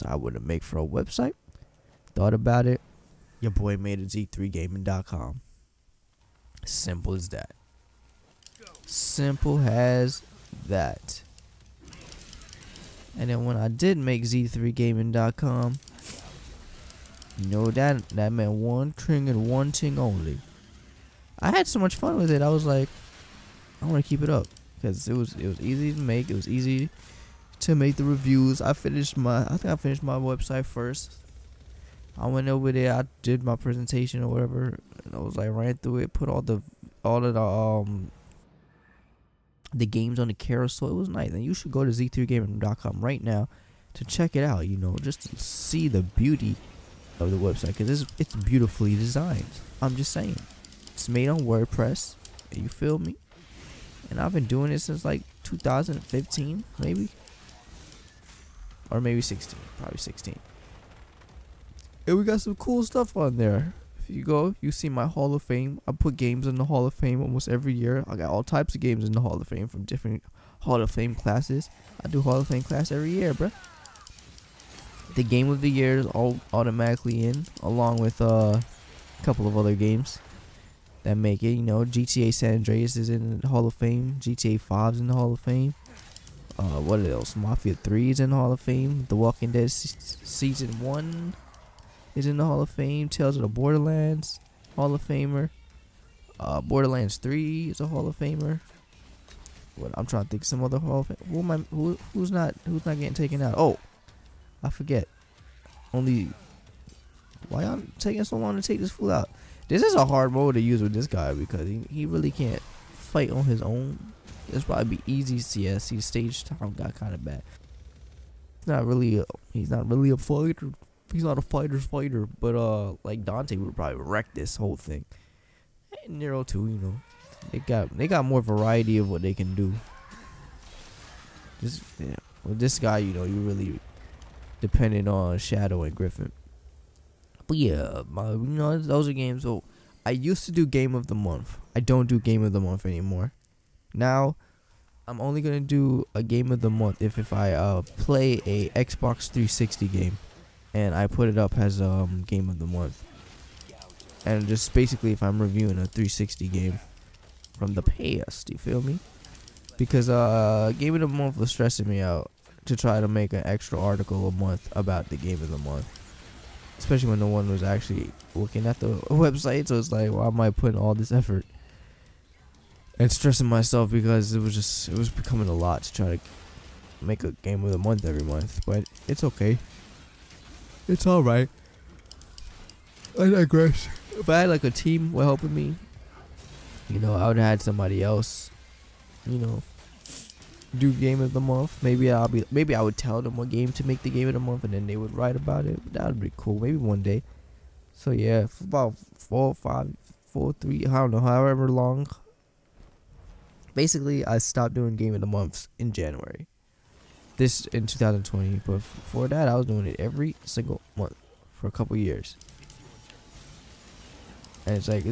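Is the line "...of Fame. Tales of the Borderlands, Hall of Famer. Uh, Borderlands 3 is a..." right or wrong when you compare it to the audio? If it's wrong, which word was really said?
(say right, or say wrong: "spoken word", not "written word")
right.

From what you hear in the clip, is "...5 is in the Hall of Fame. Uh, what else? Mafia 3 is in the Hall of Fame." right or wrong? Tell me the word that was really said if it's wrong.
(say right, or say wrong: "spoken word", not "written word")
right.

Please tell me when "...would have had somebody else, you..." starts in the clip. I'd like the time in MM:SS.
03:07.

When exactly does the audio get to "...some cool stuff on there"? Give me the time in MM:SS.
01:02.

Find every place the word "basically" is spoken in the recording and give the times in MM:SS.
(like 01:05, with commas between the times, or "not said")
02:34, 03:23.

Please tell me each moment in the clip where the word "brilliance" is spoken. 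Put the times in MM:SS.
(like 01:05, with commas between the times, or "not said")
not said.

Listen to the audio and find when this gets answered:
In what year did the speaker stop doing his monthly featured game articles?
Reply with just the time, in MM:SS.
03:27.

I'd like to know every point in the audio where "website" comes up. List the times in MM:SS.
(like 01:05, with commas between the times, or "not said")
00:00, 00:30, 00:47, 02:49.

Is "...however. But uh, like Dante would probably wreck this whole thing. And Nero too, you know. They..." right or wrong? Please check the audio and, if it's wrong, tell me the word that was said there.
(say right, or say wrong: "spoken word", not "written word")
wrong: "fighter", not "however".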